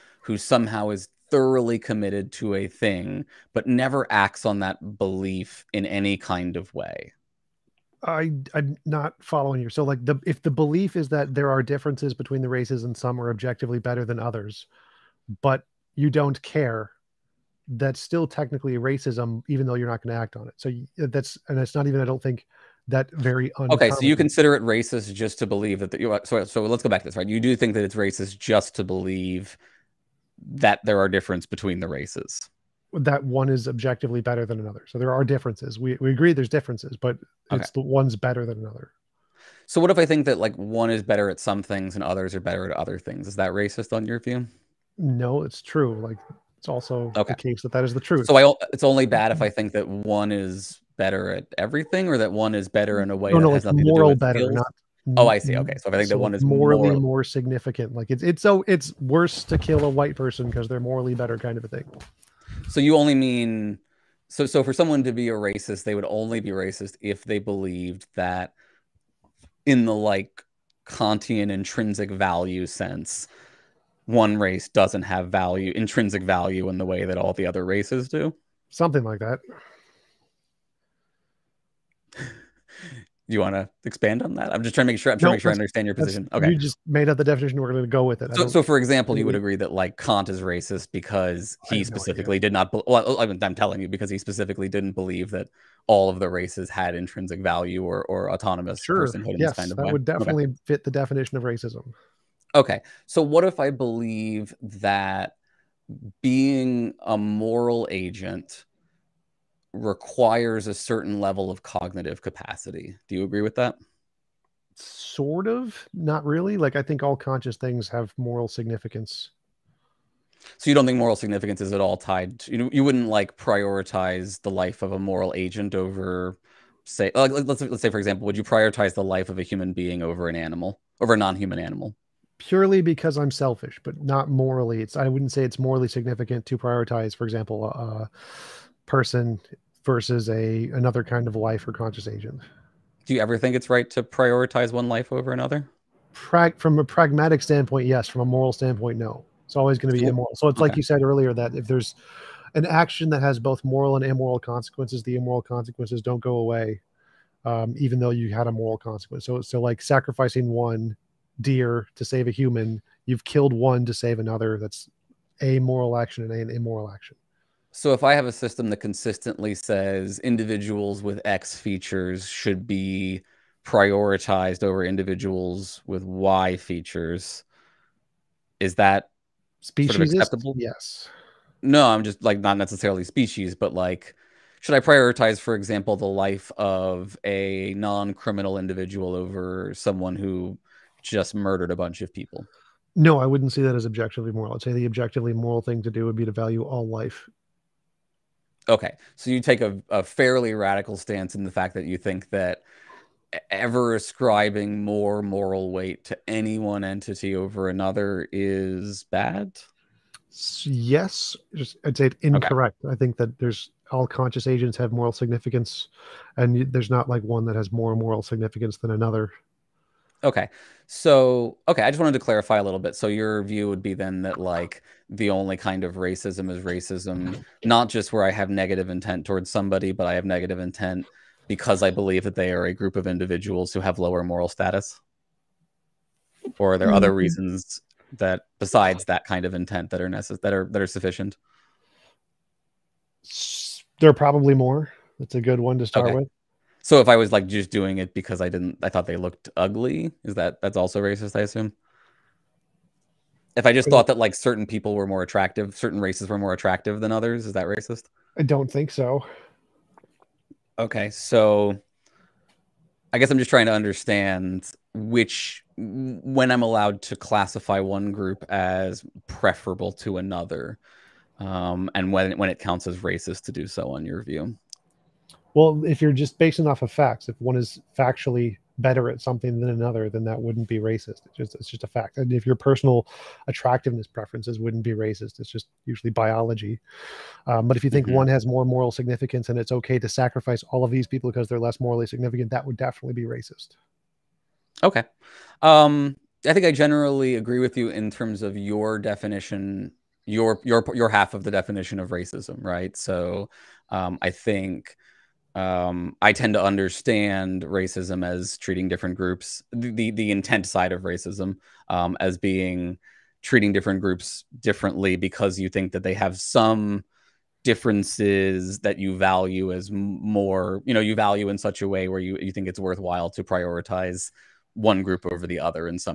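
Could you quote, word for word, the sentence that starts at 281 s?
It's just, it's just a fact.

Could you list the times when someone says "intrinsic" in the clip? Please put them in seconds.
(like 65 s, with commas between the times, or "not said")
71 s, 75 s, 96 s.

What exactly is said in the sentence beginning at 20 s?
So that's and that's not even I don't think that very uncommon.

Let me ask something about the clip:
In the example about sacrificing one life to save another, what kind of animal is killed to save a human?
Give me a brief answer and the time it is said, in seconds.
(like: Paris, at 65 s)
Deer, at 161 s.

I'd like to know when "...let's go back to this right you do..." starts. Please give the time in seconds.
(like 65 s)
26 s.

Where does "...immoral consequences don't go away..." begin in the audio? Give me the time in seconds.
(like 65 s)
155 s.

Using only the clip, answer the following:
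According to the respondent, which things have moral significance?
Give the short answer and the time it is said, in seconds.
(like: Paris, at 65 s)
All conscious things, at 117 s.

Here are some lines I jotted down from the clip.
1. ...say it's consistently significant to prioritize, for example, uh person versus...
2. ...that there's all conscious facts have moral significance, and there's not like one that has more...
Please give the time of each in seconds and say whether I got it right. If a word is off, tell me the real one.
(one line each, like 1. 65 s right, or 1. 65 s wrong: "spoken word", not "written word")
1. 135 s wrong: "morally", not "consistently"
2. 213 s wrong: "agents", not "facts".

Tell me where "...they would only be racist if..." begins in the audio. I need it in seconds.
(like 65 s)
65 s.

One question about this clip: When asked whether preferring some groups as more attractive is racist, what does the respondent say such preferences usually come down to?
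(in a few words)
Biology.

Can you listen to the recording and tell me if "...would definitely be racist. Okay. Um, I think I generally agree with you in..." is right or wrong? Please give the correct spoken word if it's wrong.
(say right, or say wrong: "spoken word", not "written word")
right.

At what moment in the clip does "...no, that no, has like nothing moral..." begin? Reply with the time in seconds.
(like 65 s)
53 s.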